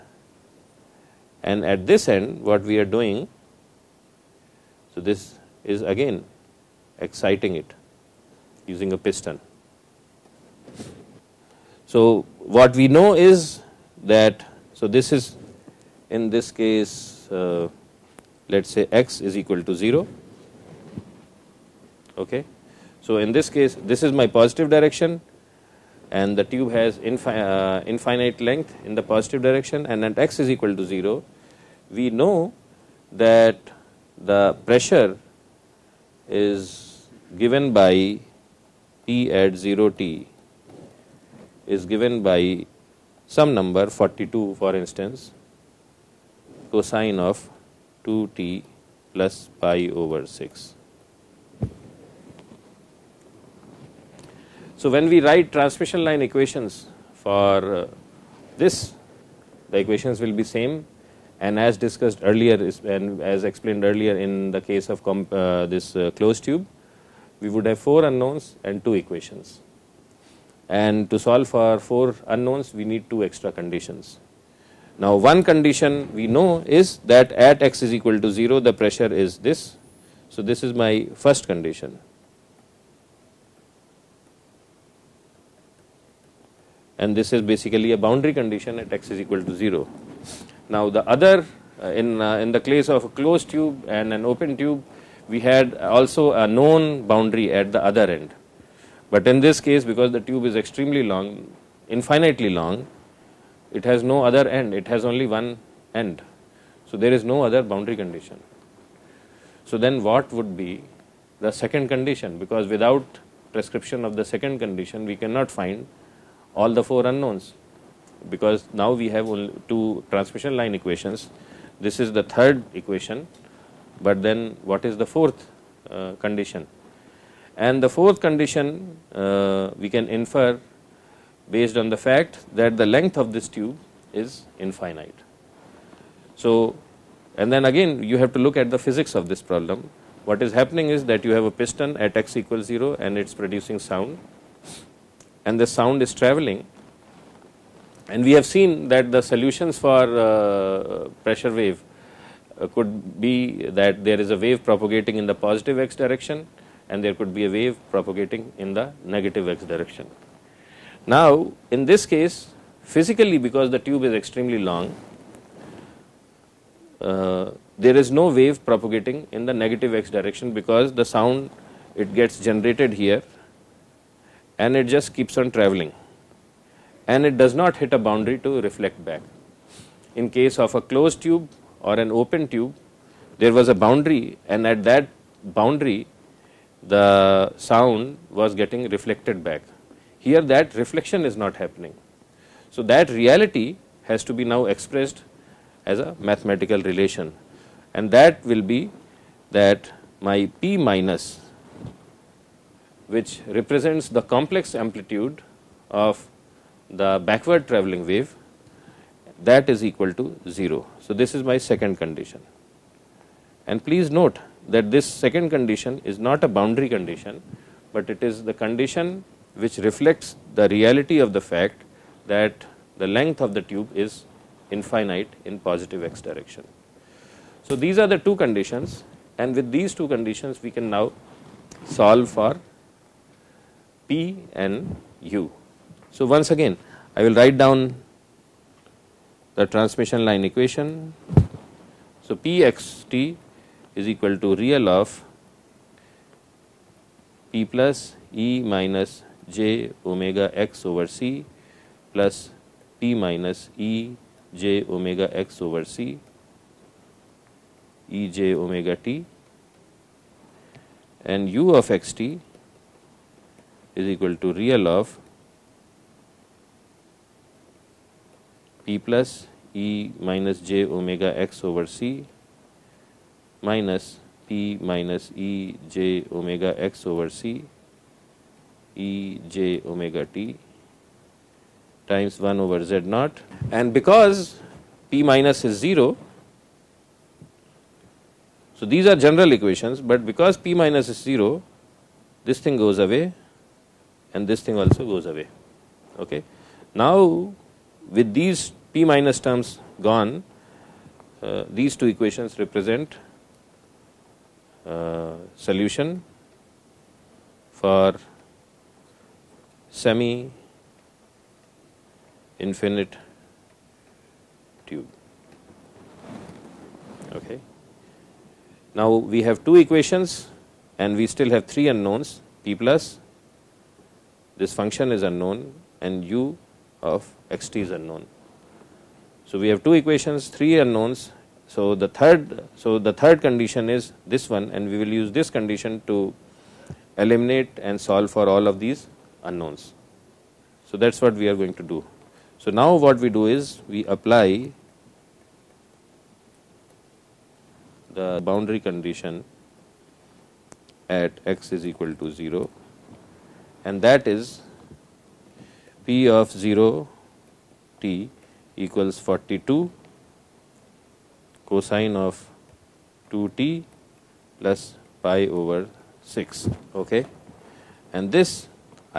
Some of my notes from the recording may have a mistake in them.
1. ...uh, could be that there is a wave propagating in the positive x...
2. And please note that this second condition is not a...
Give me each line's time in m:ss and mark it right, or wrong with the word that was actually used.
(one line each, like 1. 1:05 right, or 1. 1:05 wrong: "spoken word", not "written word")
1. 2:32 right
2. 3:33 right.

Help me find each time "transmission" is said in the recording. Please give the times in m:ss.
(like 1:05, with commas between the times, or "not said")
0:55, 2:00, 3:59.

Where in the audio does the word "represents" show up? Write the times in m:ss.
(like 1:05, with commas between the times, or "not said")
3:23, 5:02.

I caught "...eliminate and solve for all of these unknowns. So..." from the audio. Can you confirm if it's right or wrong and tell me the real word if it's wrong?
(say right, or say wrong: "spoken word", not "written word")
right.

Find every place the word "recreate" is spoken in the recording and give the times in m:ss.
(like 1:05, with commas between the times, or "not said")
not said.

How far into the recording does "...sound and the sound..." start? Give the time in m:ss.
2:23.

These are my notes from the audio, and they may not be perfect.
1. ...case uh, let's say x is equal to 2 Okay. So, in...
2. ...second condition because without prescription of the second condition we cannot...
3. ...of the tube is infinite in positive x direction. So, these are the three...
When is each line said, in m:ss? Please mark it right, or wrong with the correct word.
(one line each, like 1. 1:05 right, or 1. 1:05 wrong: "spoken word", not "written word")
1. 0:16 wrong: "0", not "2"
2. 1:51 right
3. 3:43 wrong: "two", not "three".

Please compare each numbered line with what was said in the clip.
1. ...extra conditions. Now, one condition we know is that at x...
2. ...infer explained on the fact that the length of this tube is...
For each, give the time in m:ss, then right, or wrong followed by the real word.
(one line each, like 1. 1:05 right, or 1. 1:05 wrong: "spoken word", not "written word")
1. 1:13 right
2. 2:10 wrong: "based", not "explained".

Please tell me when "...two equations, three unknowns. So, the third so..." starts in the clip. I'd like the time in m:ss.
5:29.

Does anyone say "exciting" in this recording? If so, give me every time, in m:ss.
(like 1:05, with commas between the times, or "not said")
0:06.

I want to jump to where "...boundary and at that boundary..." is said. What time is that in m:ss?
3:03.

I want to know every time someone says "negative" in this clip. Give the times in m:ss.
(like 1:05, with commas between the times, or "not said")
2:39, 2:49.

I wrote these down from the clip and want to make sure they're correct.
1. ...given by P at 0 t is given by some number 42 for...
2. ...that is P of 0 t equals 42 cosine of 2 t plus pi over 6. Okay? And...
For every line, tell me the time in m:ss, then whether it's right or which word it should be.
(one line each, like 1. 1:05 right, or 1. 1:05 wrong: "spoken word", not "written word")
1. 0:37 right
2. 5:54 right.